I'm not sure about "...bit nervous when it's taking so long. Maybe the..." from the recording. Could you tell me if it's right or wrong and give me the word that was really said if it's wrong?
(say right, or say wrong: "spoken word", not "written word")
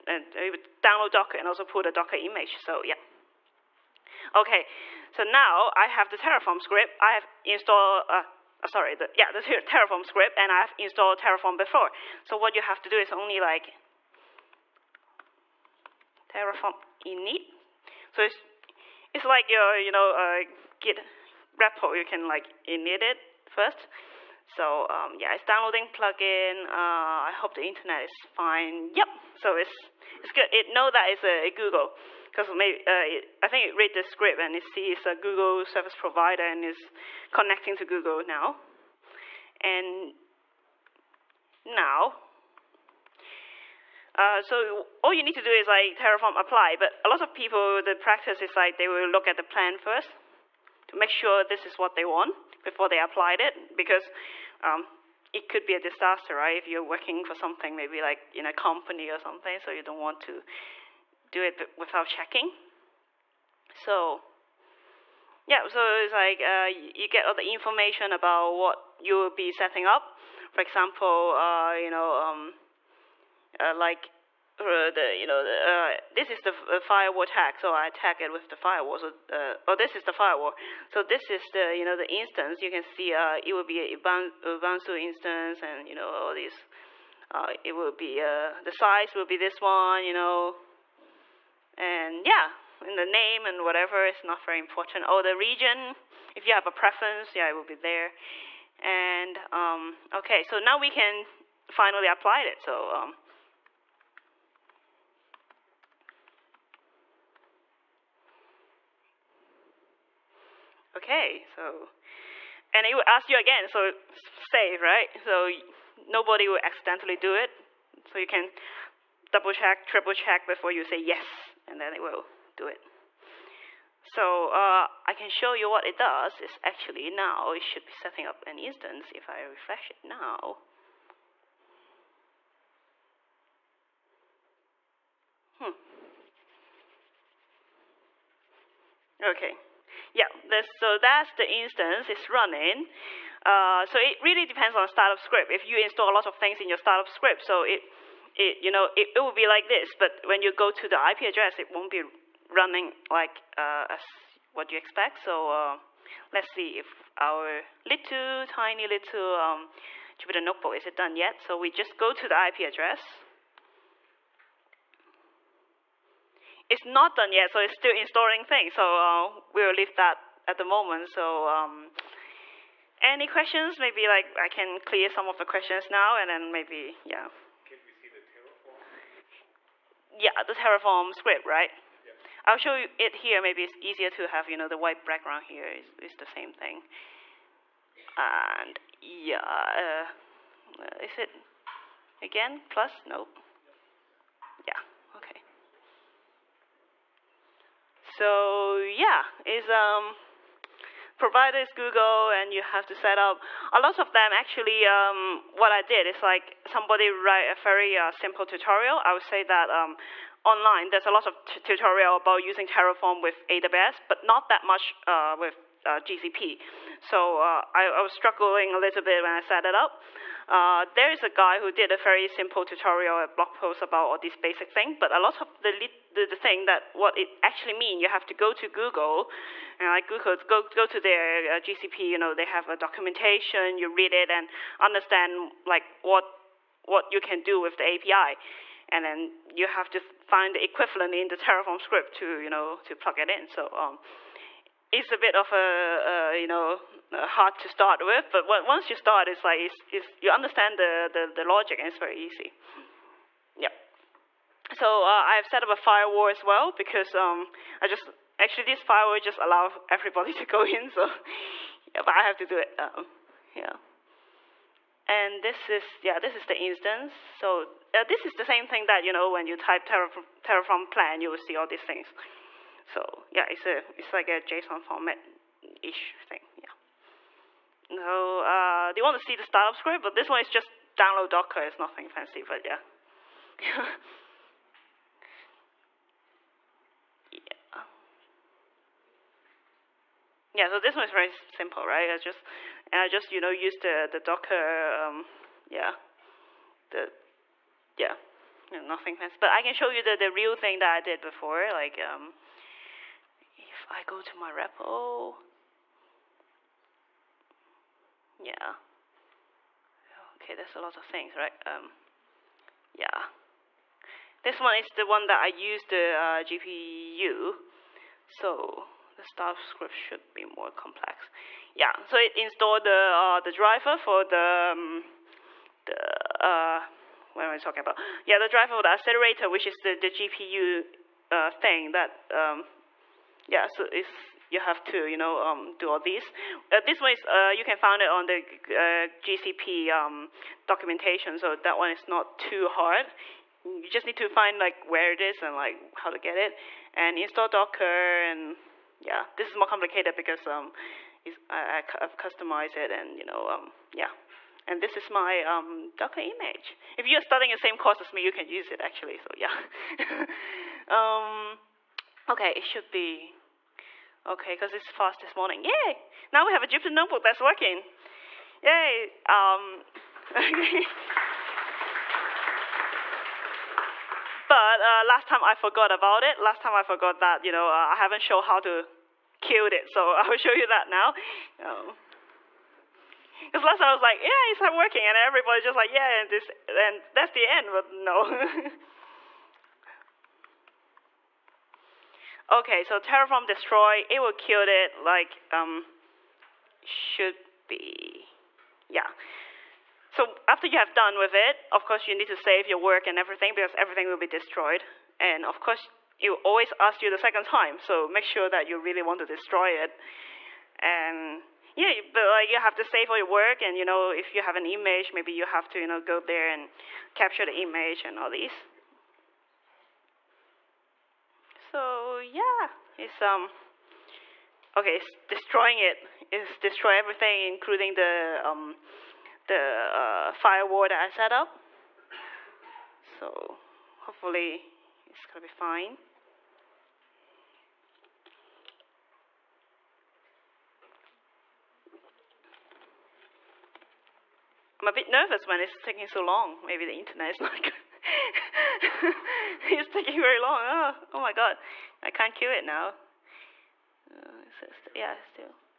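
right.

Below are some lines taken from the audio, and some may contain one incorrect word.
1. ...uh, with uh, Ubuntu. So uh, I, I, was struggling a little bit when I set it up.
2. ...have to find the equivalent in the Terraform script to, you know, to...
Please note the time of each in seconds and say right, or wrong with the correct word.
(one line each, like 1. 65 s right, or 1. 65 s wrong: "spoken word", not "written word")
1. 215 s wrong: "GCP", not "Ubuntu"
2. 239 s right.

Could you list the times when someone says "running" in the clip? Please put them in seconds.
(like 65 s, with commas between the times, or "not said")
142 s, 152 s.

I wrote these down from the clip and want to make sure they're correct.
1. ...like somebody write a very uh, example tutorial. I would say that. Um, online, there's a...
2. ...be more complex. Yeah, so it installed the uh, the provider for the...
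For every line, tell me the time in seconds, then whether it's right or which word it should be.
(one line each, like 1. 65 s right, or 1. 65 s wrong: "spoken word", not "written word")
1. 206 s wrong: "simple", not "example"
2. 320 s wrong: "driver", not "provider".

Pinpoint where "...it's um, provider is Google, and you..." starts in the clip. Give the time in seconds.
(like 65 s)
199 s.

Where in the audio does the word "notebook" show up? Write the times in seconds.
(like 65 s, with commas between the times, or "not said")
160 s, 366 s.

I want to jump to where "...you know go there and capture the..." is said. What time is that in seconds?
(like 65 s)
415 s.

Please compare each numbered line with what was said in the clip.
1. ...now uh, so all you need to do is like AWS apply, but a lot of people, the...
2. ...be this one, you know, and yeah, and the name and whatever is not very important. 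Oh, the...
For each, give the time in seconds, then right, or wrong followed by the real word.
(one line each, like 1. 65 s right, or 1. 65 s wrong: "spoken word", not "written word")
1. 41 s wrong: "Terraform", not "AWS"
2. 89 s right.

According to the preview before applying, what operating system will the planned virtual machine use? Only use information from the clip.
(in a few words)
Ubuntu.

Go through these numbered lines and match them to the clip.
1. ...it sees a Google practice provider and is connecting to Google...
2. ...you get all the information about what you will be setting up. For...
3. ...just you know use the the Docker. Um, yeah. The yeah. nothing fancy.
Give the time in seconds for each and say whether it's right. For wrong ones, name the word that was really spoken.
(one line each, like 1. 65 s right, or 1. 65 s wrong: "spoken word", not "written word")
1. 34 s wrong: "service", not "practice"
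2. 66 s right
3. 293 s right.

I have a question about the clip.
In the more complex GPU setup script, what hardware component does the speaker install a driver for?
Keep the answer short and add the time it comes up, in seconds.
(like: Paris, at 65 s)
the accelerator, at 328 s.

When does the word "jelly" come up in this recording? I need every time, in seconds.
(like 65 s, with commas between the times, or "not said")
not said.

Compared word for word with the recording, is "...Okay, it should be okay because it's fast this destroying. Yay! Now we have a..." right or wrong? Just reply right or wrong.
wrong.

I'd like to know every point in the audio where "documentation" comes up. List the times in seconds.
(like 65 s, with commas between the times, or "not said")
232 s, 340 s.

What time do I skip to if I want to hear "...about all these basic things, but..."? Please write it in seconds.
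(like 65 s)
223 s.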